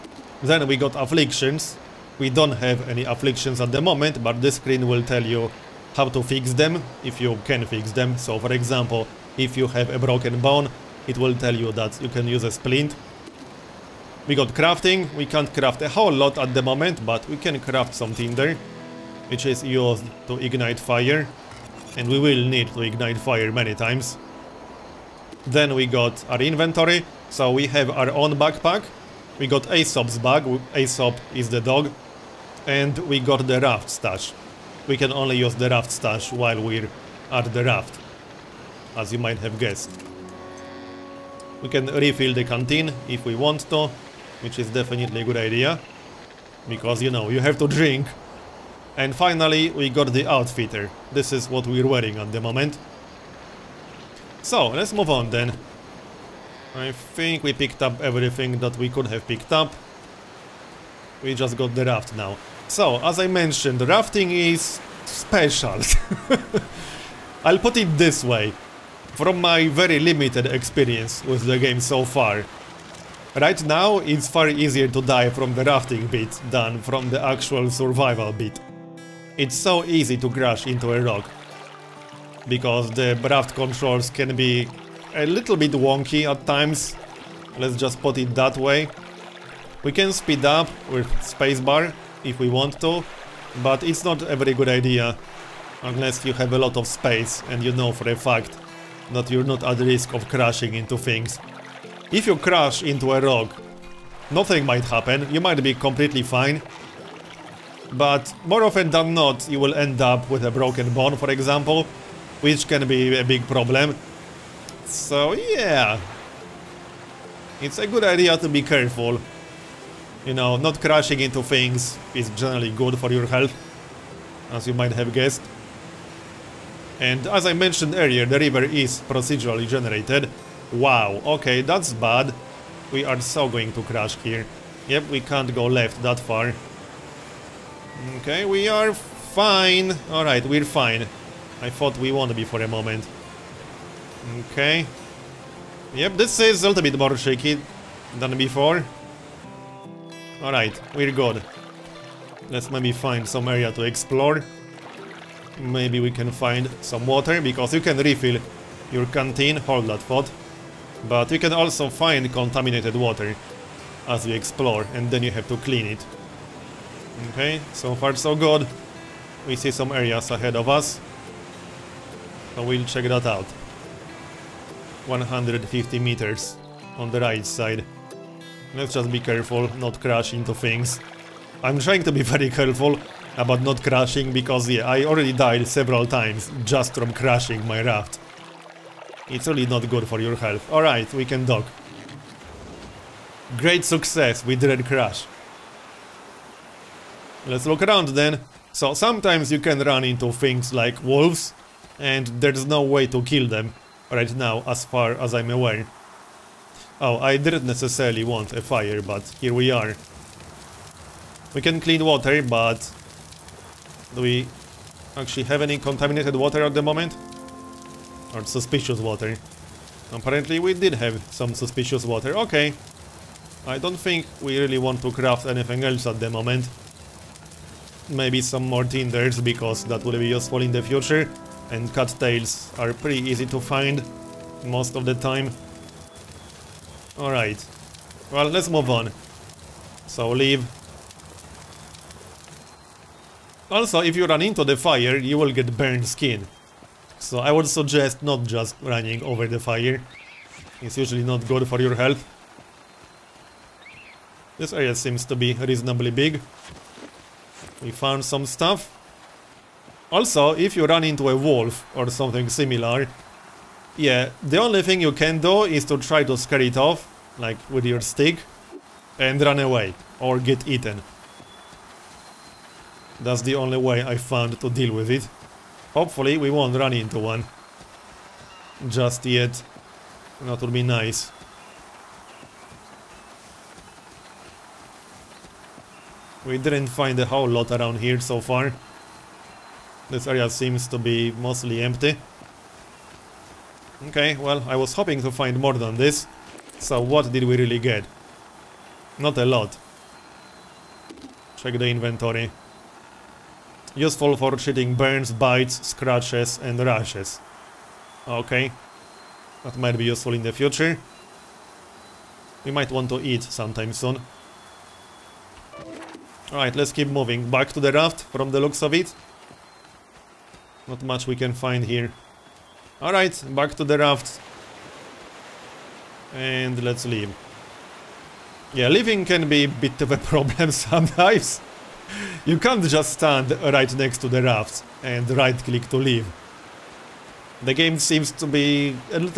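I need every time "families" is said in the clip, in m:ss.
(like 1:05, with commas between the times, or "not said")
not said.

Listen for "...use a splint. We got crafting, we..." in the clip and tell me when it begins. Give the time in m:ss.
0:12.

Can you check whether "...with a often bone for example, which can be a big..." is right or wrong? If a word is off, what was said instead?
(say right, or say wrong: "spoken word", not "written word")
wrong: "broken", not "often".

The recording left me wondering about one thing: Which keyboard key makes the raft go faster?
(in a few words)
spacebar.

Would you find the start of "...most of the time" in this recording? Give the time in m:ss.
3:54.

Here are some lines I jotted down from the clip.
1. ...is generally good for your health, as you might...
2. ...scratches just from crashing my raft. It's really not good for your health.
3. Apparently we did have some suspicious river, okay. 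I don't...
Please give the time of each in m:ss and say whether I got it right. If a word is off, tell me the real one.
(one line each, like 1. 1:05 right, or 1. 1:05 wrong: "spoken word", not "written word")
1. 2:02 right
2. 3:06 wrong: "times", not "scratches"
3. 3:40 wrong: "water", not "river".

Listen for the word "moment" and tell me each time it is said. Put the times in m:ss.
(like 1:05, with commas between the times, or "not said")
0:03, 0:16, 0:52, 2:22, 3:36, 3:46.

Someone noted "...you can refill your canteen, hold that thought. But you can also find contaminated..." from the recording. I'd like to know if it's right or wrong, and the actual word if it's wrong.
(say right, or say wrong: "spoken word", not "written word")
right.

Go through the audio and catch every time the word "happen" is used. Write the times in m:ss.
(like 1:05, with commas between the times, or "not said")
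1:44.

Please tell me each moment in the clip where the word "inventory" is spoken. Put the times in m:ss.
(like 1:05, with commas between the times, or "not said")
0:26, 5:01.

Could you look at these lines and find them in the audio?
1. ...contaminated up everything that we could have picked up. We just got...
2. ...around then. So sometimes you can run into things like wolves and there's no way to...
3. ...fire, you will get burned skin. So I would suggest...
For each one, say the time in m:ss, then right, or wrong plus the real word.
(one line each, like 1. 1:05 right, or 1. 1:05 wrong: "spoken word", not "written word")
1. 0:57 wrong: "picked", not "contaminated"
2. 3:17 right
3. 4:04 right.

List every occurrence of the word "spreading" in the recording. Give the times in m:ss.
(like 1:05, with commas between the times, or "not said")
not said.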